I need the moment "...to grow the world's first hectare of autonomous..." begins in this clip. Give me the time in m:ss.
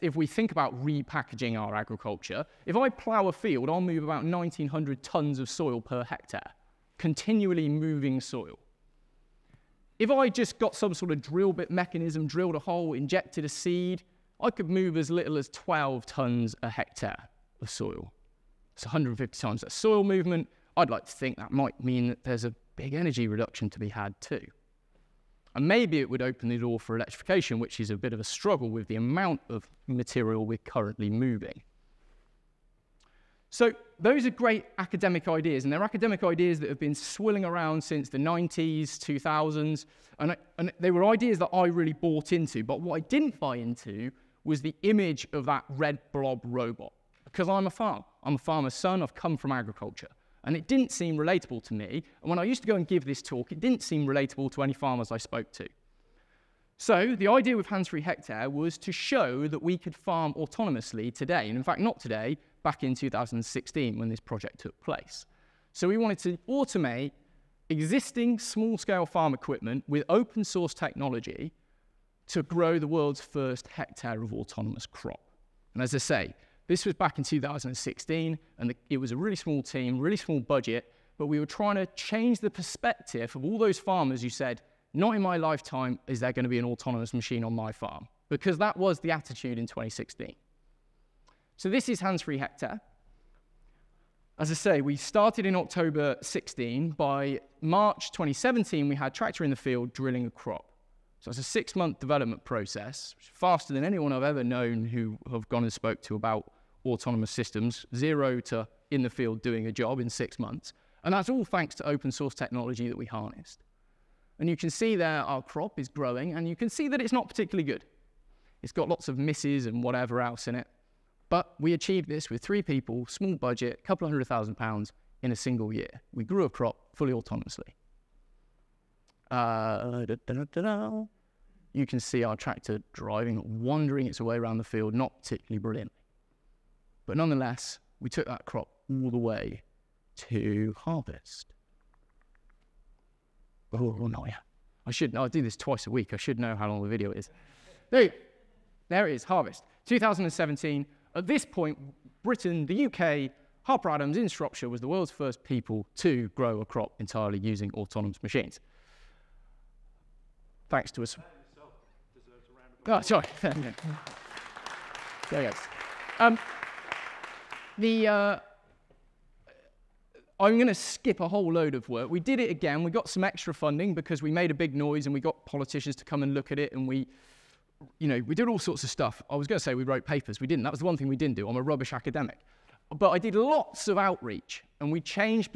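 1:12.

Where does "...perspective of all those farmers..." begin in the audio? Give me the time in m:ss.
1:22.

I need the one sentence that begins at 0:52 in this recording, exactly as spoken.
And when I used to go and give this talk, it didn't seem relatable to any farmers I spoke to.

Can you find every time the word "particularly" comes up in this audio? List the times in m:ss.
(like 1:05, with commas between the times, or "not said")
1:57, 2:15.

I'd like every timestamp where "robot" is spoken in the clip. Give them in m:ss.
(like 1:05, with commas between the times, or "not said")
0:46.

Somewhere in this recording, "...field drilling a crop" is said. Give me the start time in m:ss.
1:39.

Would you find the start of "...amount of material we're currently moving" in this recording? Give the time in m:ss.
0:28.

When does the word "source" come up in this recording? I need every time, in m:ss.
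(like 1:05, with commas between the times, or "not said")
1:10, 1:52.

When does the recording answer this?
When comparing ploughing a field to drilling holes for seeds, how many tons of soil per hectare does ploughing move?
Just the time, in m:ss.
0:04.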